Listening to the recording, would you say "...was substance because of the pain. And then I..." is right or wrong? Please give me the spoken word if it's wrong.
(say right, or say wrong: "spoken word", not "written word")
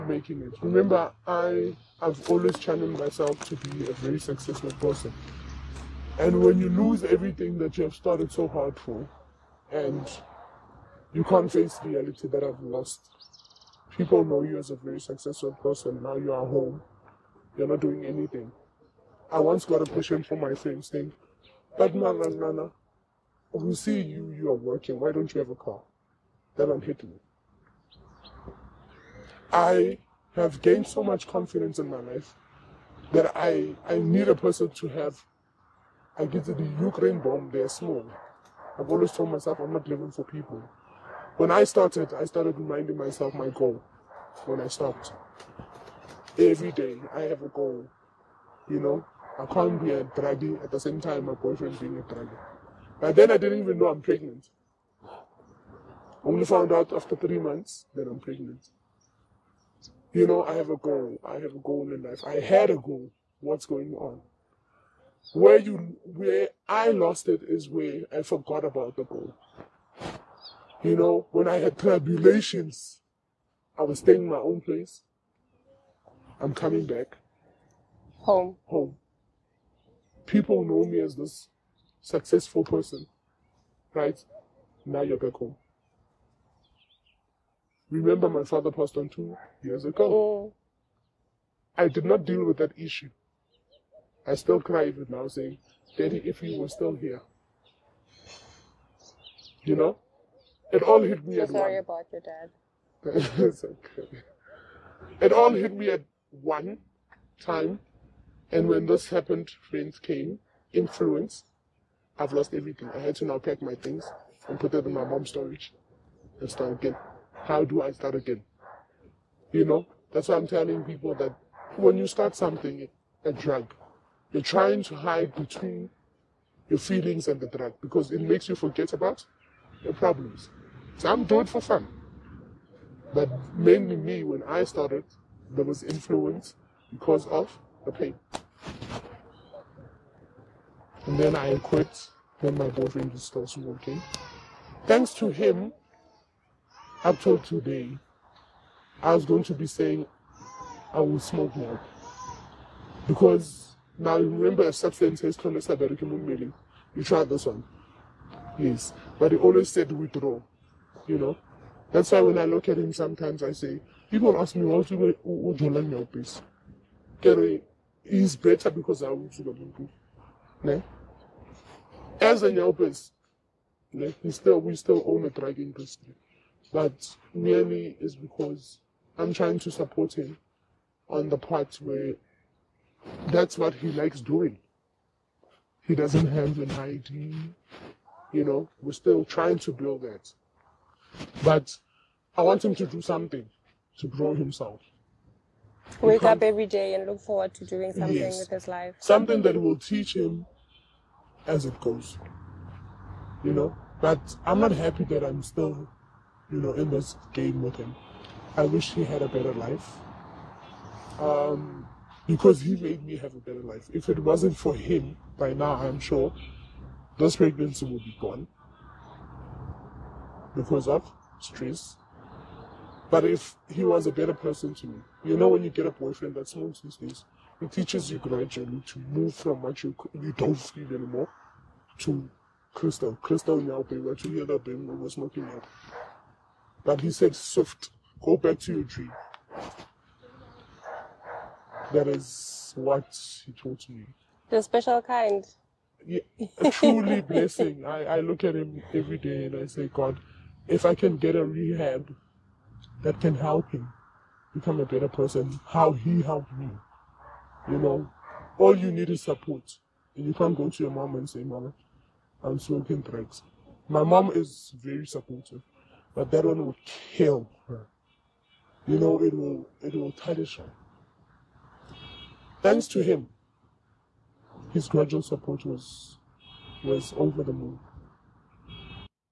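wrong: "influence", not "substance".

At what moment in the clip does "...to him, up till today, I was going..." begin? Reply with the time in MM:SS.
02:25.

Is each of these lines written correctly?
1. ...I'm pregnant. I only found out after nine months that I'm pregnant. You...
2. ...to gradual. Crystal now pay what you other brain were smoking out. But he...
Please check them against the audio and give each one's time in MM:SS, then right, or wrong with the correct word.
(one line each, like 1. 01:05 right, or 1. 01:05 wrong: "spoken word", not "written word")
1. 00:53 wrong: "three", not "nine"
2. 03:51 wrong: "crystal", not "gradual".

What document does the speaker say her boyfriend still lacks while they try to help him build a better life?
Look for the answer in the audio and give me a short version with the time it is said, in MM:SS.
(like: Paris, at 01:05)
ID, at 03:06.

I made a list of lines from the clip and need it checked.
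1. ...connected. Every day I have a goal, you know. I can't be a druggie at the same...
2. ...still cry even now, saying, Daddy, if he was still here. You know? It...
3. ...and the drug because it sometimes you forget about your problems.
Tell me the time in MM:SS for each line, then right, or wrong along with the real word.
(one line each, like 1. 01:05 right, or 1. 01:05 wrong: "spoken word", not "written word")
1. 00:44 wrong: "stopped", not "connected"
2. 01:34 right
3. 02:07 wrong: "makes", not "sometimes".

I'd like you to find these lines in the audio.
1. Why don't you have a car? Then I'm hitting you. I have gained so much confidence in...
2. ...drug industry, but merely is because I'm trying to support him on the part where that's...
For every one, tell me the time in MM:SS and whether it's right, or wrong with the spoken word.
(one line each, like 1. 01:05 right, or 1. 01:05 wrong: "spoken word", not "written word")
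1. 00:24 right
2. 02:55 right.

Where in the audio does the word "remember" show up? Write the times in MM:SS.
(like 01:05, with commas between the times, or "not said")
00:00, 01:27, 02:34.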